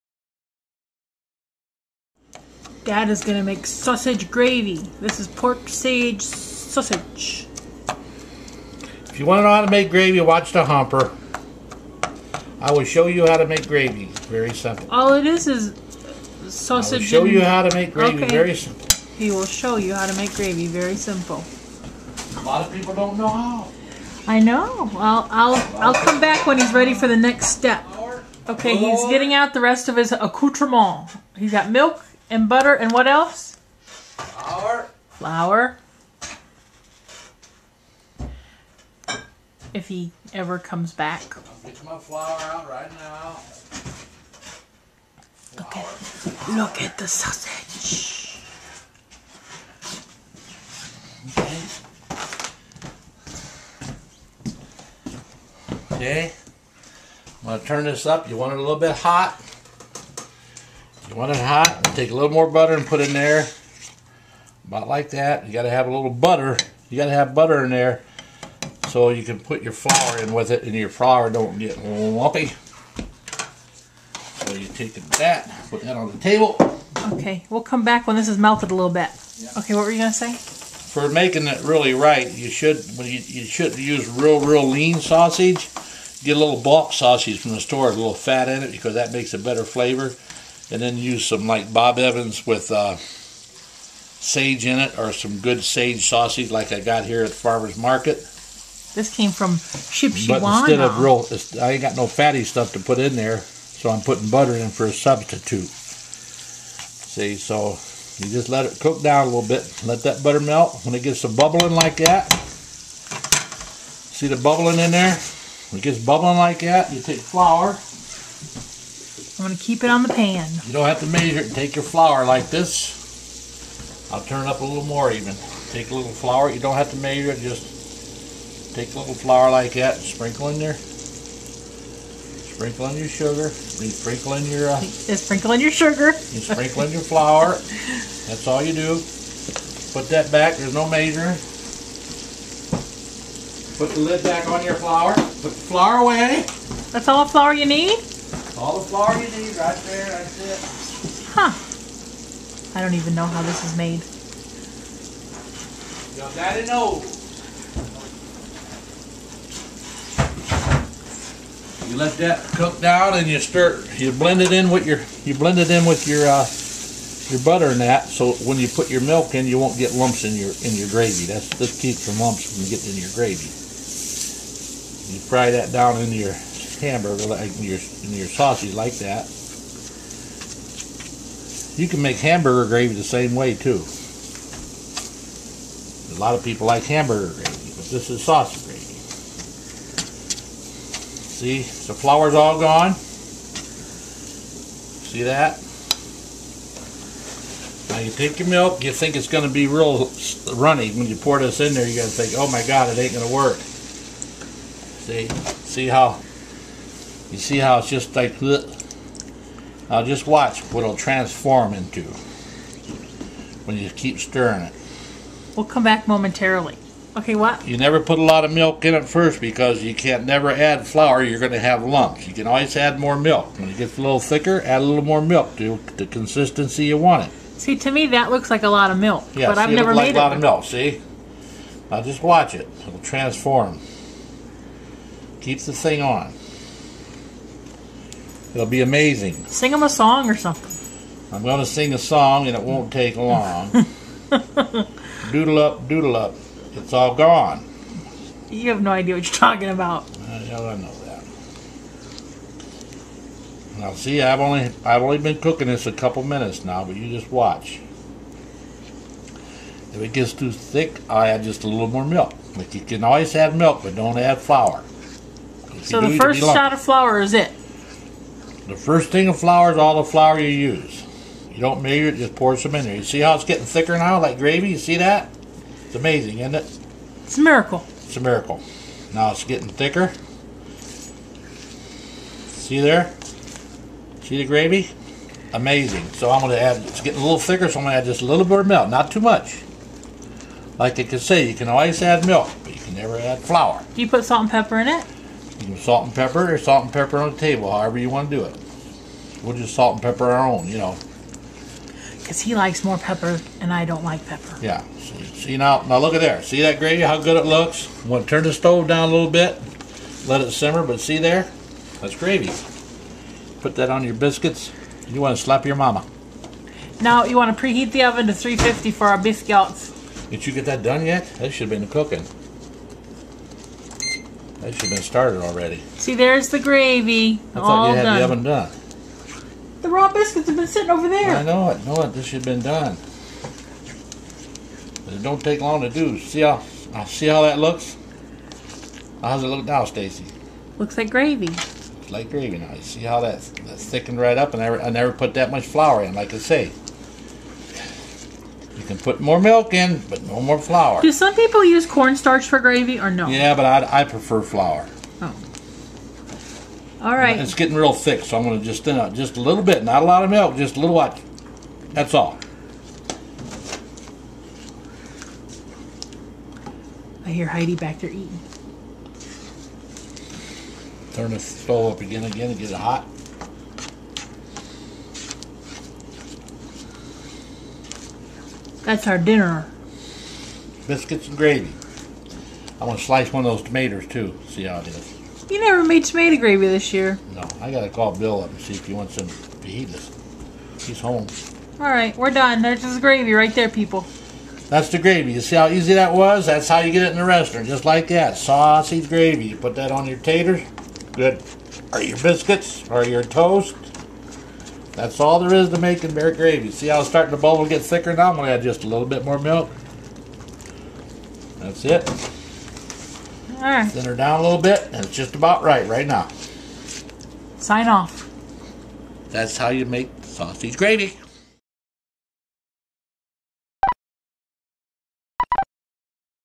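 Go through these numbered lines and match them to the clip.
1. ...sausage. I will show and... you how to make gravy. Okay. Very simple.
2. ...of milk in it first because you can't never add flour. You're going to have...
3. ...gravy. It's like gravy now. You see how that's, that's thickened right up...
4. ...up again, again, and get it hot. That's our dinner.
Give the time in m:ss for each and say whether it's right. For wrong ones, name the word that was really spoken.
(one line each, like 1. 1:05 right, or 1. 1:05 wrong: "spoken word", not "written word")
1. 0:16 right
2. 3:38 right
3. 5:41 right
4. 6:11 right.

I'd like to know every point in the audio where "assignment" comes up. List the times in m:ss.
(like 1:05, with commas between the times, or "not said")
not said.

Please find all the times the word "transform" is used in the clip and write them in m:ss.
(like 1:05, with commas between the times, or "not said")
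3:30, 3:52.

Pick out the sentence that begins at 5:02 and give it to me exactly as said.
Because he likes more pepper and I don't like pepper.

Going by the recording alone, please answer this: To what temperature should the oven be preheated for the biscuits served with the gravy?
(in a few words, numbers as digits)
350.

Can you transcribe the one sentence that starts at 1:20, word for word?
For making it really right, you should when you, you should use real, real lean sausage.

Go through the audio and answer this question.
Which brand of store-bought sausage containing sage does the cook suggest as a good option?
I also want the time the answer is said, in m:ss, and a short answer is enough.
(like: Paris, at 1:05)
Bob Evans, at 1:31.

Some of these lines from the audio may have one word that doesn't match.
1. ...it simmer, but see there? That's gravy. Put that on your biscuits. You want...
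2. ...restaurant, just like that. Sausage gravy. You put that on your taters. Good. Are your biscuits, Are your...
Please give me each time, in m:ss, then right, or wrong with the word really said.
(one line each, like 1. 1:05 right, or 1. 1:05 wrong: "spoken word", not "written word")
1. 5:10 right
2. 6:37 right.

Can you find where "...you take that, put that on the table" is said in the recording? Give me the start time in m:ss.
1:14.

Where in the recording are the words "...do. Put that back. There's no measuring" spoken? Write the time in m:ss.
2:18.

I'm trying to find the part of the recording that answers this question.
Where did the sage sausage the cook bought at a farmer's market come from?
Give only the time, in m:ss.
1:39.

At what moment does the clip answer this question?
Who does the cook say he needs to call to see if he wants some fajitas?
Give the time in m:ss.
6:28.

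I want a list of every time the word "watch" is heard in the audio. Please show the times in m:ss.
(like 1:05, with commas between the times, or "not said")
0:10, 3:30, 3:52, 4:17.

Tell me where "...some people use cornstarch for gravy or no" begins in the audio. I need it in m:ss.
5:51.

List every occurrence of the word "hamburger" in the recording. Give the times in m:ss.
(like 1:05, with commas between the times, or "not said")
2:56, 3:02, 3:06.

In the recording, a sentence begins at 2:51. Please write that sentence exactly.
That's this keeps your lumps from getting in your gravy.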